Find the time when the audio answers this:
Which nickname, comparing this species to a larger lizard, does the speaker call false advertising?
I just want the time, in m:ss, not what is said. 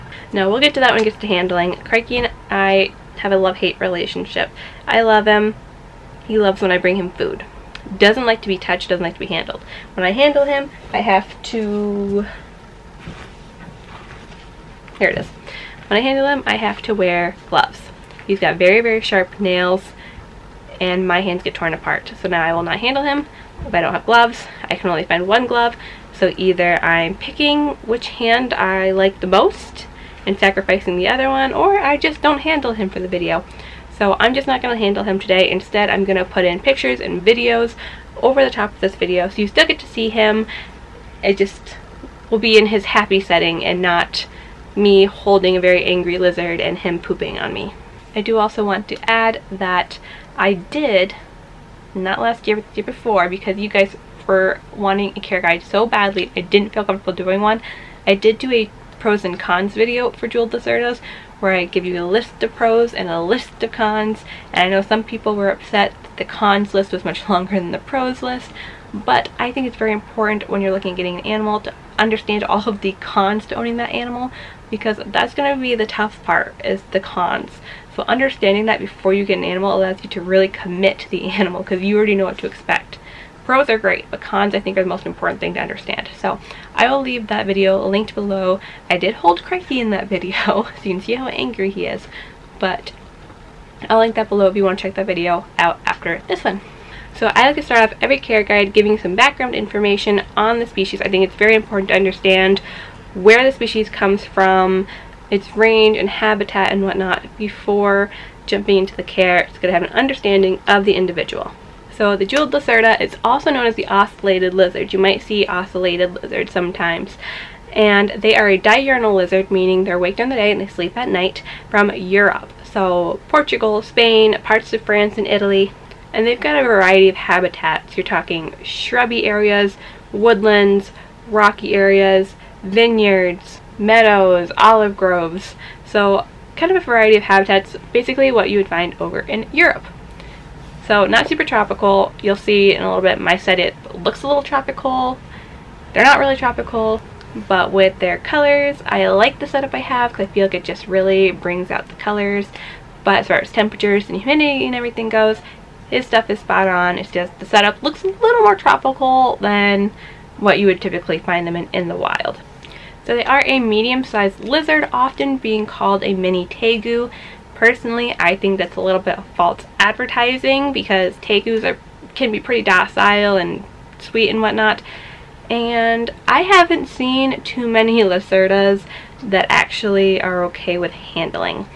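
2:46.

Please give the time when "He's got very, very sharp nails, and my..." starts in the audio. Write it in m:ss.
0:18.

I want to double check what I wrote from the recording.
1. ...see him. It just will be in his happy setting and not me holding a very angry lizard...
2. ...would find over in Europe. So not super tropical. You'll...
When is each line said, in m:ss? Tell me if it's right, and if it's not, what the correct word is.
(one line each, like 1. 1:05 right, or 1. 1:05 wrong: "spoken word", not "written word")
1. 0:39 right
2. 2:18 right.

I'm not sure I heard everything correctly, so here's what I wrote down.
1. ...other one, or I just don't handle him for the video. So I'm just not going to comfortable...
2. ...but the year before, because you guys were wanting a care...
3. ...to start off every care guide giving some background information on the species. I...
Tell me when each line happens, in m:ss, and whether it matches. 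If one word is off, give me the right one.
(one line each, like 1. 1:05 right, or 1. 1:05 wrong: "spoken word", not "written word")
1. 0:31 wrong: "handle", not "comfortable"
2. 0:52 right
3. 1:37 right.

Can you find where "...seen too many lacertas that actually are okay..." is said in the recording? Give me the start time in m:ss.
2:56.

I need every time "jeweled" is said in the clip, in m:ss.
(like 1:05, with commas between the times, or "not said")
1:00, 1:52.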